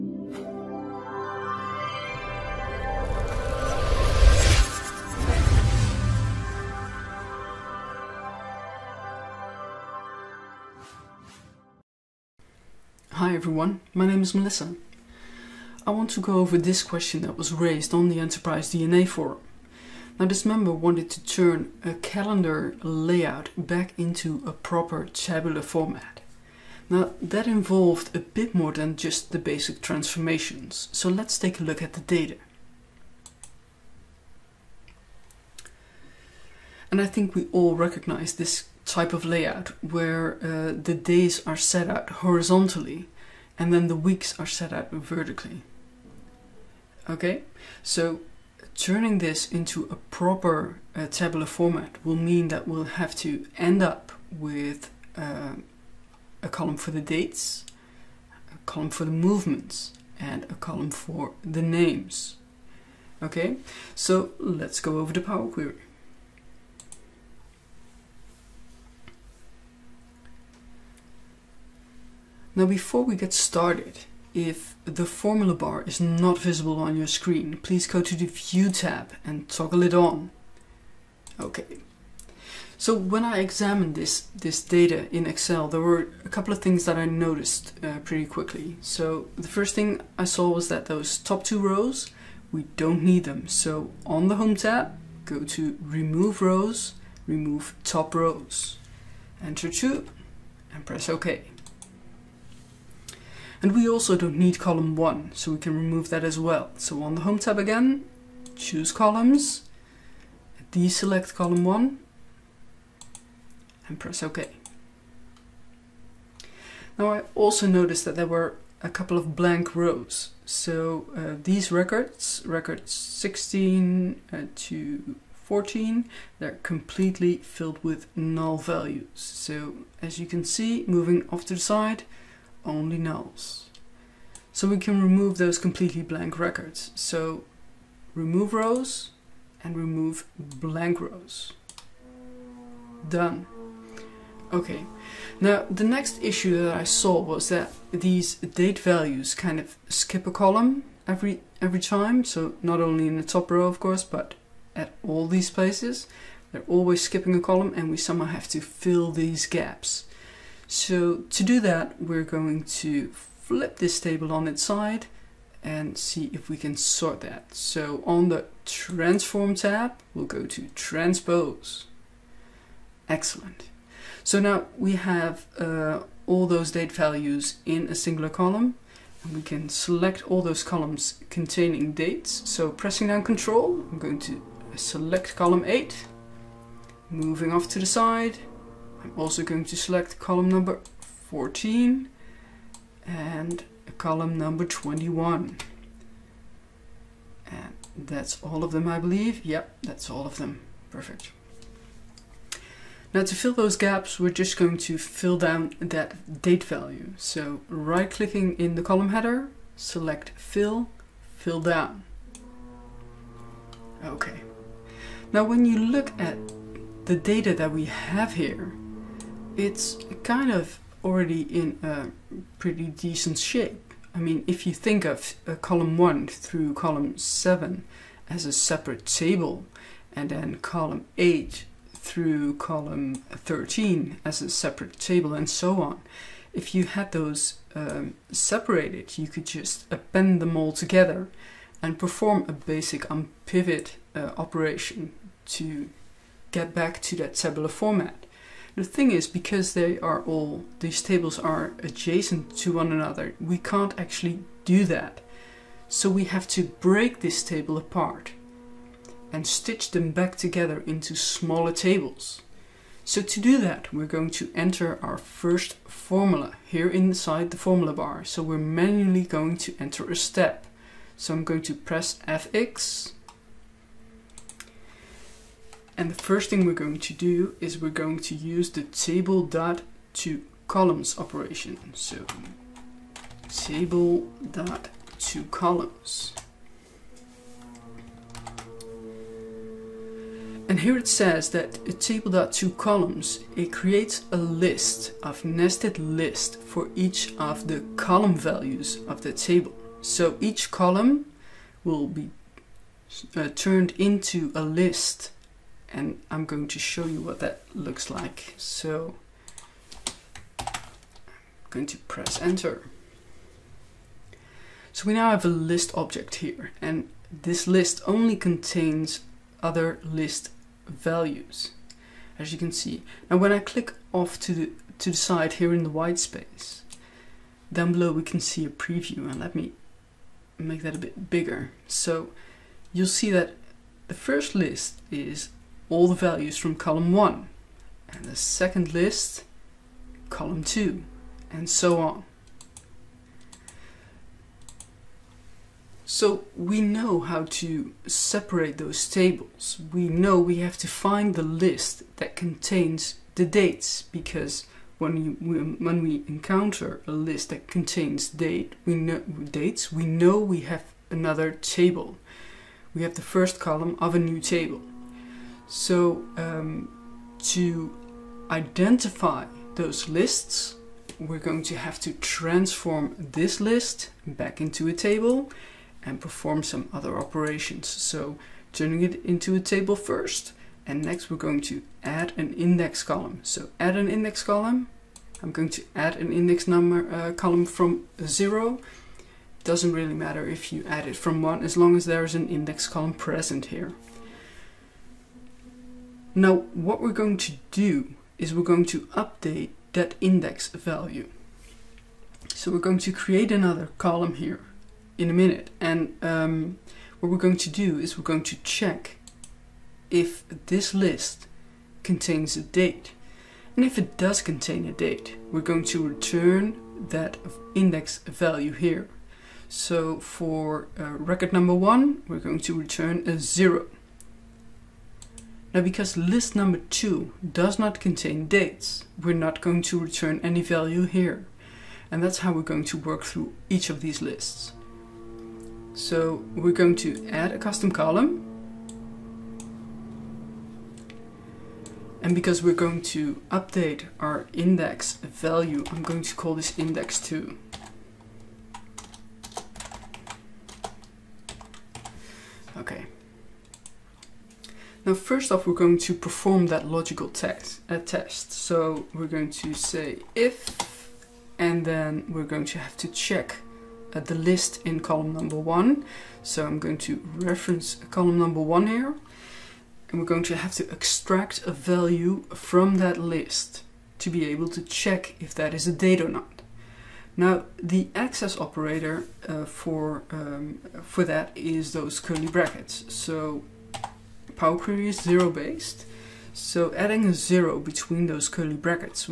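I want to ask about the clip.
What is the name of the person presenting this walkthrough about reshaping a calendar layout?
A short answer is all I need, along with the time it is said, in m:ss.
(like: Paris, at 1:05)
Melissa, at 0:14.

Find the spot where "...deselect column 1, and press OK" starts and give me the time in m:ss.
1:50.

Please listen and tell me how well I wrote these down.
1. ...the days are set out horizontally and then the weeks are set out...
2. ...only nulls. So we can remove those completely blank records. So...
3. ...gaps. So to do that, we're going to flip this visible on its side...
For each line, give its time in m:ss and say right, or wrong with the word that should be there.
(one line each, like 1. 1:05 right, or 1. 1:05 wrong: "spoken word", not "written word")
1. 0:40 right
2. 2:12 right
3. 2:39 wrong: "table", not "visible".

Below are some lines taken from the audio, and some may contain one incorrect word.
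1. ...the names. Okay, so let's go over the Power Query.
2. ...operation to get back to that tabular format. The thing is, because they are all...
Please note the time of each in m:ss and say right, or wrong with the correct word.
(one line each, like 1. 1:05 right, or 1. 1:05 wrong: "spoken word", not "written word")
1. 1:01 right
2. 4:04 right.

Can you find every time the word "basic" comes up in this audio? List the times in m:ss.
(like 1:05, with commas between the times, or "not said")
0:29, 4:02.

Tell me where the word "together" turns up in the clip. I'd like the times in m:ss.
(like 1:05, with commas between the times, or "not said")
4:00, 4:20.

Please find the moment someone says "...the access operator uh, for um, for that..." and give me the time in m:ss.
7:57.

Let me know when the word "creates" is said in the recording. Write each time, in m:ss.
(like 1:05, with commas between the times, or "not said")
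4:53, 6:43.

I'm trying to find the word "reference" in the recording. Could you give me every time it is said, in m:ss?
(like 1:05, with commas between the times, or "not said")
7:47.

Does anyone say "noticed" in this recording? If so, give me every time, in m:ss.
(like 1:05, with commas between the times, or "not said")
1:27, 1:57.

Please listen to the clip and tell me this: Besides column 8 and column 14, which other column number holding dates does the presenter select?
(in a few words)
21.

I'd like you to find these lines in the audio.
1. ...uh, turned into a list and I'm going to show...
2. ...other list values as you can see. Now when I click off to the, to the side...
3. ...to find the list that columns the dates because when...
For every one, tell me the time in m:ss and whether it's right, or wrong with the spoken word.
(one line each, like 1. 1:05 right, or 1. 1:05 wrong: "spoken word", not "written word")
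1. 5:03 right
2. 5:19 right
3. 5:50 wrong: "contains", not "columns".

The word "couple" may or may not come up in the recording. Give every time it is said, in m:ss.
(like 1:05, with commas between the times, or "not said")
1:26, 1:58.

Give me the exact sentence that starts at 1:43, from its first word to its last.
And we also don't need column 1, so we can remove that as well.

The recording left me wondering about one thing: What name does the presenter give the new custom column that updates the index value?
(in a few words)
Index 2.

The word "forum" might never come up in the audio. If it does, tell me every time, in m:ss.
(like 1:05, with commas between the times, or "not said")
0:19.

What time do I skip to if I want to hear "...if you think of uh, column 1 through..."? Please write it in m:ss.
3:44.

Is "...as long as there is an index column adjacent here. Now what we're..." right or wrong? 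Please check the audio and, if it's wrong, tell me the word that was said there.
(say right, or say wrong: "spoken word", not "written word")
wrong: "present", not "adjacent".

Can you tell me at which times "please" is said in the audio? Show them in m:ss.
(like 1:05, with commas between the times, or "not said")
1:17.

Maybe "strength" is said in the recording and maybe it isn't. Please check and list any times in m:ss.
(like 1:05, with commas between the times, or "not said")
not said.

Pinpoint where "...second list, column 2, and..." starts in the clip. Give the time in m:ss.
5:38.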